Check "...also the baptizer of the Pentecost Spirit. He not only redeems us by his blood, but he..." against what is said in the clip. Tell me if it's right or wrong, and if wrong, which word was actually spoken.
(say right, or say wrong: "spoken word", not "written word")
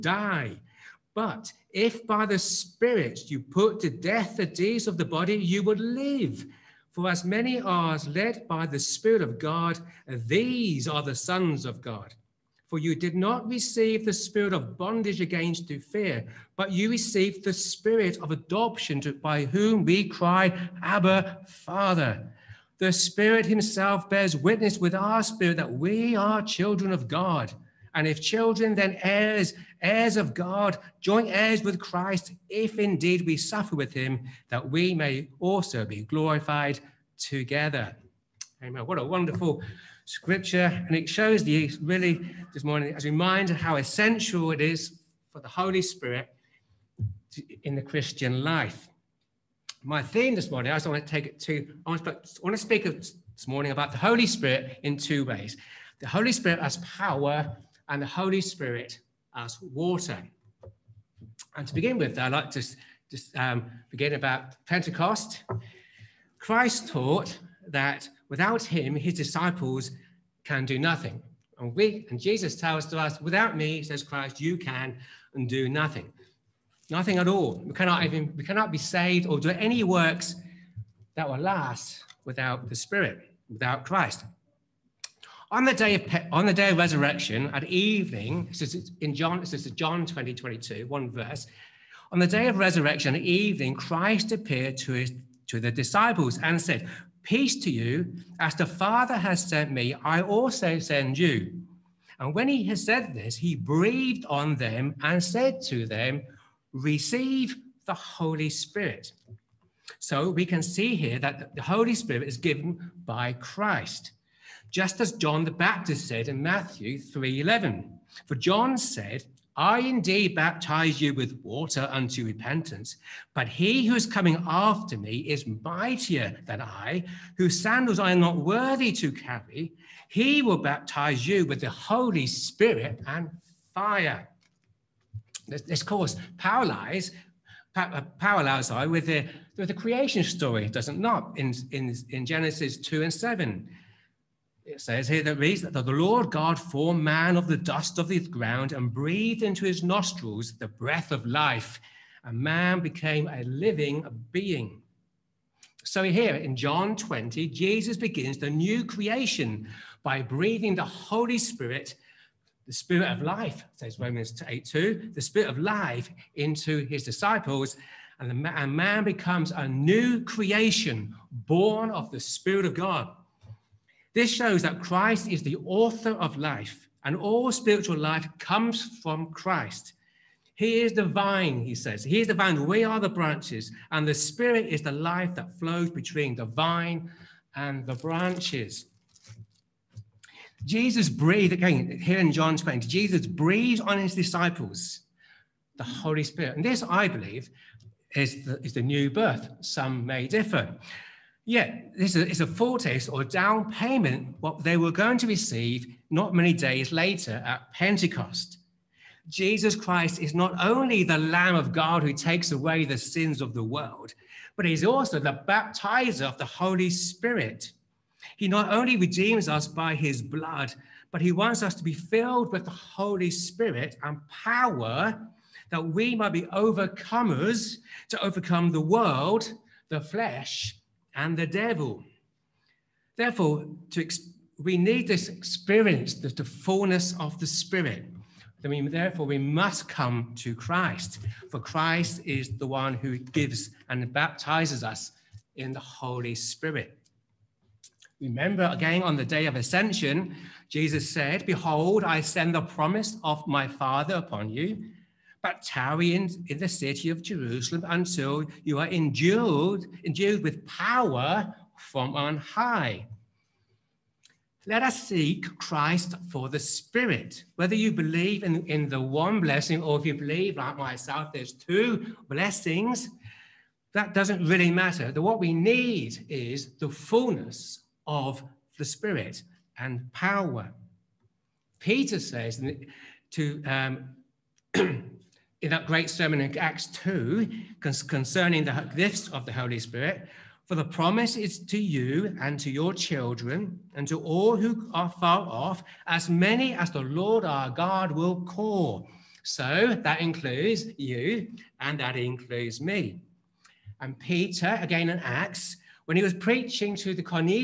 wrong: "Holy", not "Pentecost".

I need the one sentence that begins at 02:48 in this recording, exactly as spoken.
And, the, and man becomes a new creation born of the Spirit of God.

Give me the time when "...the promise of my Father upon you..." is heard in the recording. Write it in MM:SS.
04:12.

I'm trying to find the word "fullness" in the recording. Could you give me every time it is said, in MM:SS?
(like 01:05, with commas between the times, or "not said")
03:56, 04:36.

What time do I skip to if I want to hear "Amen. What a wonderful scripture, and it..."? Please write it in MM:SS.
00:38.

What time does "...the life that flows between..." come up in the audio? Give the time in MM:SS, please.
03:04.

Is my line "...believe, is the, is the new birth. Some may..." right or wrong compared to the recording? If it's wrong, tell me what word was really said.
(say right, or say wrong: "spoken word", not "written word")
right.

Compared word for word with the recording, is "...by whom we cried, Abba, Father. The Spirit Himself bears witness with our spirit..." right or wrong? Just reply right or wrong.
right.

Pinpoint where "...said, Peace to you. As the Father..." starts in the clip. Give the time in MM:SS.
01:36.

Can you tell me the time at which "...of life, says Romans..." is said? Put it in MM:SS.
02:43.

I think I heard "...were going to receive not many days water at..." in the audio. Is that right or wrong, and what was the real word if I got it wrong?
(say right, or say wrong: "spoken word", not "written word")
wrong: "later", not "water".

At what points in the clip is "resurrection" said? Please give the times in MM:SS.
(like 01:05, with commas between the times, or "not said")
01:26, 01:32.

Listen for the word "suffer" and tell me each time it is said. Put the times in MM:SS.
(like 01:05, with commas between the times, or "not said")
00:33.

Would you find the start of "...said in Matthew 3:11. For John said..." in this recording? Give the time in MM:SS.
01:56.